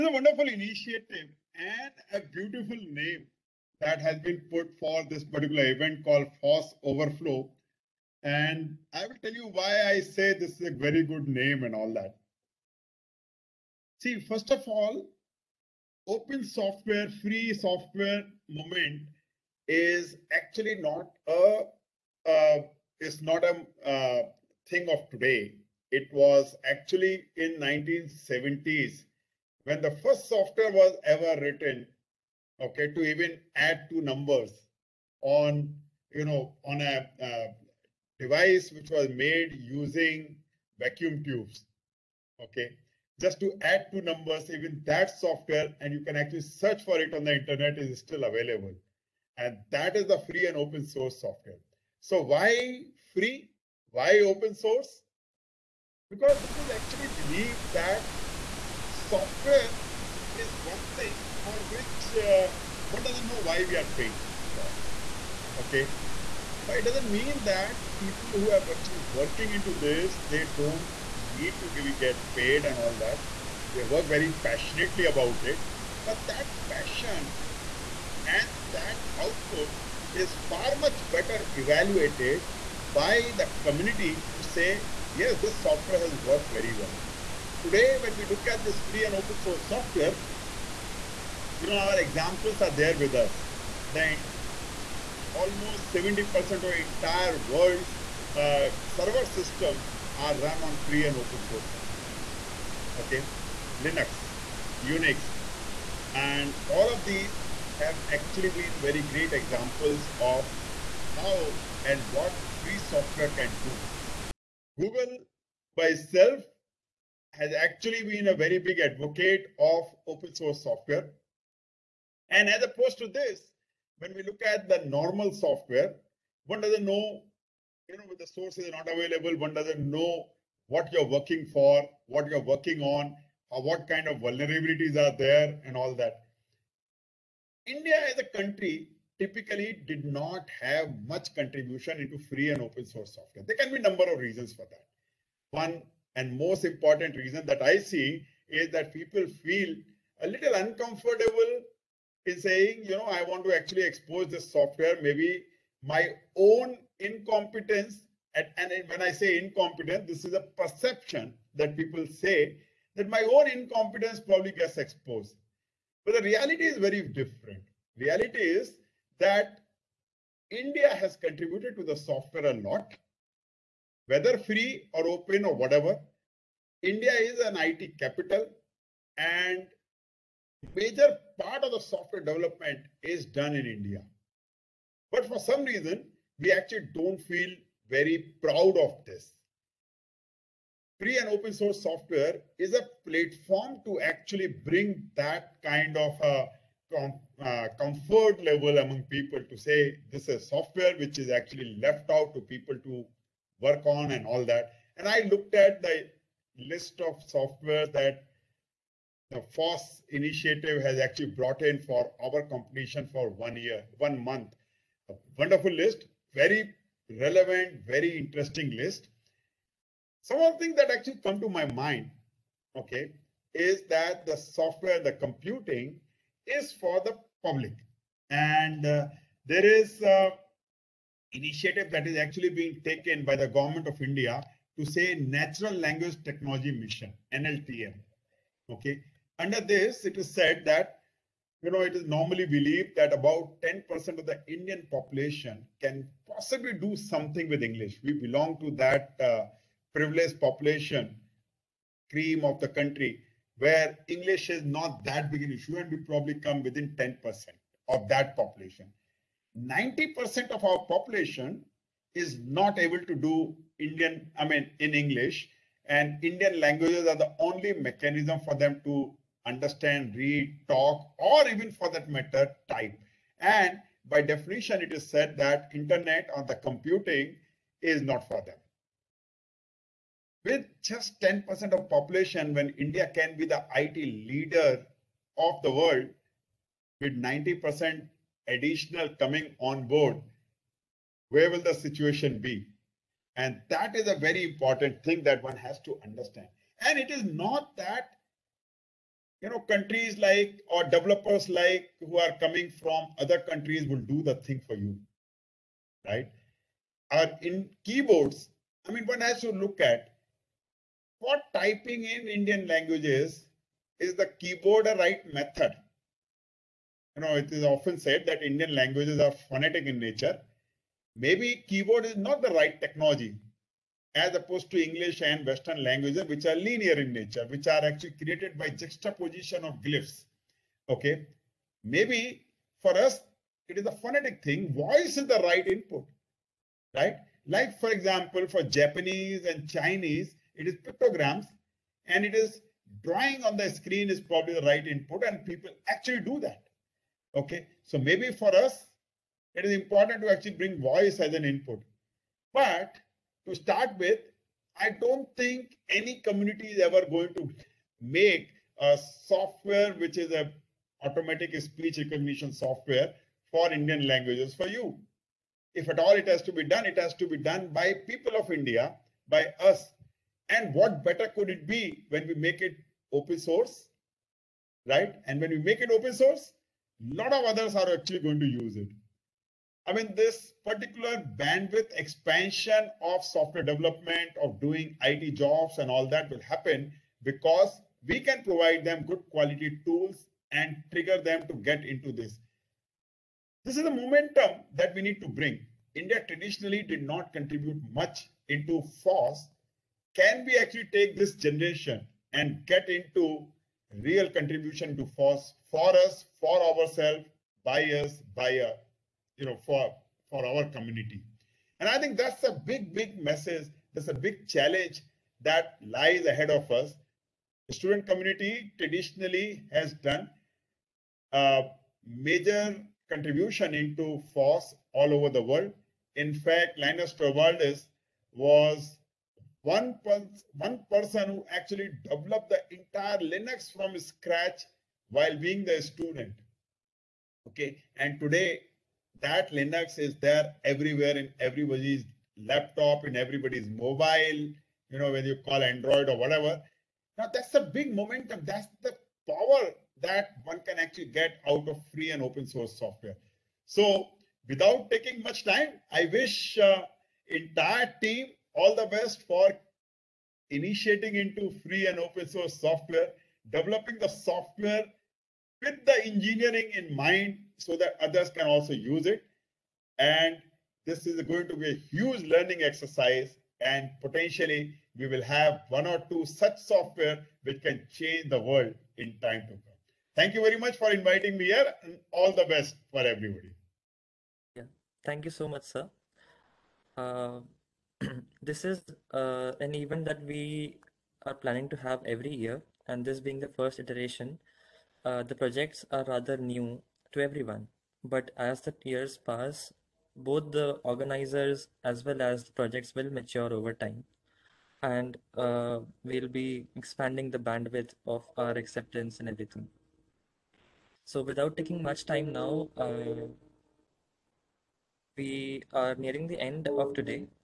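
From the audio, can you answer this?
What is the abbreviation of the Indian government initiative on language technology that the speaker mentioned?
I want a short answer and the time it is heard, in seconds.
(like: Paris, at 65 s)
NLTM, at 237 s.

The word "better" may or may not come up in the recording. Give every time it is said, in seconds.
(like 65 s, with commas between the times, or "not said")
81 s, 371 s.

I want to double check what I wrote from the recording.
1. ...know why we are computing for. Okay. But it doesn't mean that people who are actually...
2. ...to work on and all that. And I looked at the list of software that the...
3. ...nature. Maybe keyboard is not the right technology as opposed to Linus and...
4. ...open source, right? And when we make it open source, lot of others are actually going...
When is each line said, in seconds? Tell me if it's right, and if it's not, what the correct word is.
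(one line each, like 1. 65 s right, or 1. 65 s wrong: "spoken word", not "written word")
1. 63 s wrong: "paying", not "computing"
2. 202 s right
3. 319 s wrong: "English", not "Linus"
4. 373 s right.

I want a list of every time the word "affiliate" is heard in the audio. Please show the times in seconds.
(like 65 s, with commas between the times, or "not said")
not said.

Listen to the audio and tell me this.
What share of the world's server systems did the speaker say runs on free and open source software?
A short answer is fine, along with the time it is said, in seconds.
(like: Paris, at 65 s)
70%, at 95 s.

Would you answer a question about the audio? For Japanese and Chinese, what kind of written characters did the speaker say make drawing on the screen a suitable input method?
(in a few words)
pictograms.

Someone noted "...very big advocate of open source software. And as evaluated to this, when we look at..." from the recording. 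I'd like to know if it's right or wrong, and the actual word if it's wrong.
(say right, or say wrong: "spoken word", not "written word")
wrong: "opposed", not "evaluated".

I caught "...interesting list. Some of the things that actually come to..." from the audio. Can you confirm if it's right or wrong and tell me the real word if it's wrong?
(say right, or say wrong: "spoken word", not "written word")
right.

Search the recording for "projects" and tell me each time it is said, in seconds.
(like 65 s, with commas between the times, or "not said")
495 s, 502 s.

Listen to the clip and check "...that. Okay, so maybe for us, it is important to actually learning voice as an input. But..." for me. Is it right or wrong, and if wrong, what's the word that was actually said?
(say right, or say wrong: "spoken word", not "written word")
wrong: "bring", not "learning".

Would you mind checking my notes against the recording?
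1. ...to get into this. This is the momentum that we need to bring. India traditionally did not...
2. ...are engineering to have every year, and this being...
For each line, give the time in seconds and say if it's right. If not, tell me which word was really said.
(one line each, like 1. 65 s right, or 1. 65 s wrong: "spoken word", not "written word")
1. 391 s right
2. 491 s wrong: "planning", not "engineering".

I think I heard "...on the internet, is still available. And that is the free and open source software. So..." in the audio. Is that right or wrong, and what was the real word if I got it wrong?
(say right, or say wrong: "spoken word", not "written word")
right.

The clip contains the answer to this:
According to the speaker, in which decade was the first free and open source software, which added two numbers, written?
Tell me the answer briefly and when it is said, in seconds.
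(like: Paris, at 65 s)
1970s, at 27 s.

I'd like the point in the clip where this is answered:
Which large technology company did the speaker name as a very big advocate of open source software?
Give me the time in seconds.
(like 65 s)
114 s.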